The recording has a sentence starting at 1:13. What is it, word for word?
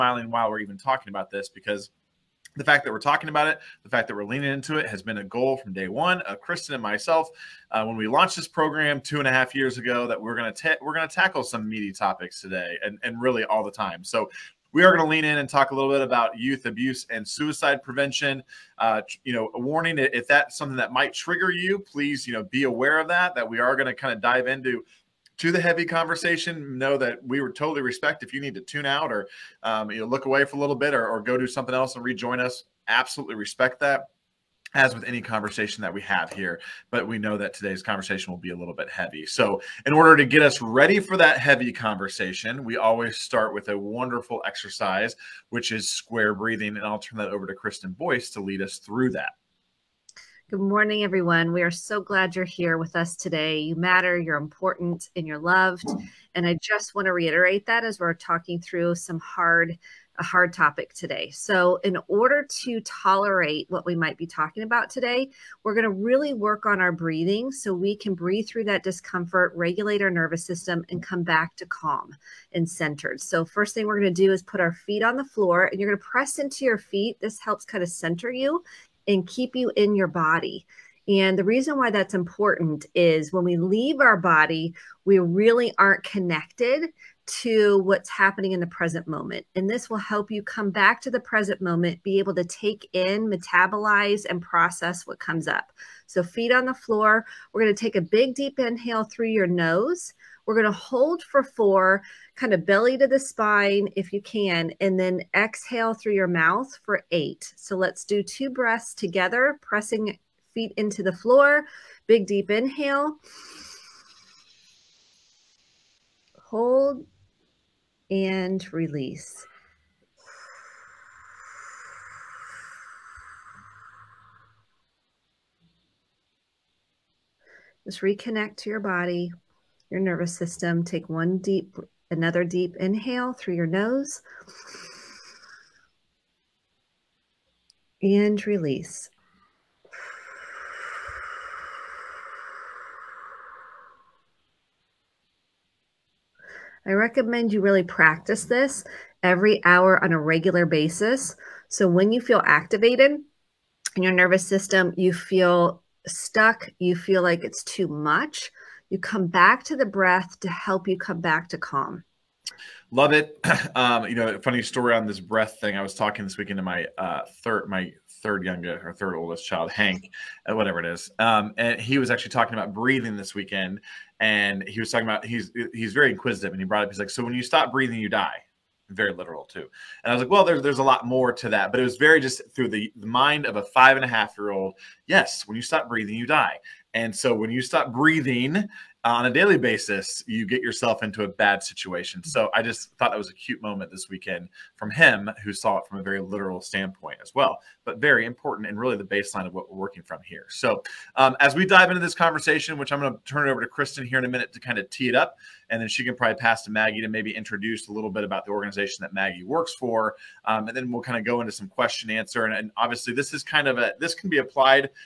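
So, first thing we're going to do is put our feet on the floor and you're going to press into your feet.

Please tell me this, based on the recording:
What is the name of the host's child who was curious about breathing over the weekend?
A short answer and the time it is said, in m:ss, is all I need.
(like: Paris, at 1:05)
Hank, at 2:49.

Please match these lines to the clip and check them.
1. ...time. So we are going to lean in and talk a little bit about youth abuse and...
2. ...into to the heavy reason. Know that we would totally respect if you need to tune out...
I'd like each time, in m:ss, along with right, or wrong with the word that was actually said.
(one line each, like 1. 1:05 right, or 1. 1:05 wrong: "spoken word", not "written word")
1. 0:13 right
2. 0:24 wrong: "conversation", not "reason".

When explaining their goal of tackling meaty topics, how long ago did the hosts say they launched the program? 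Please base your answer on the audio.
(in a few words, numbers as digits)
2.5 years.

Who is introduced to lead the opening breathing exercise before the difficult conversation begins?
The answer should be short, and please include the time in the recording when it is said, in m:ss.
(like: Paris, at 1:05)
Kristen Boice, at 0:47.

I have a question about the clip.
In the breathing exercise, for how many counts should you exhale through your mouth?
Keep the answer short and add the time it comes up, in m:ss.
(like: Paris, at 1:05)
8, at 1:47.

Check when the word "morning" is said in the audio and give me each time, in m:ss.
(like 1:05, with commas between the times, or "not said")
0:50.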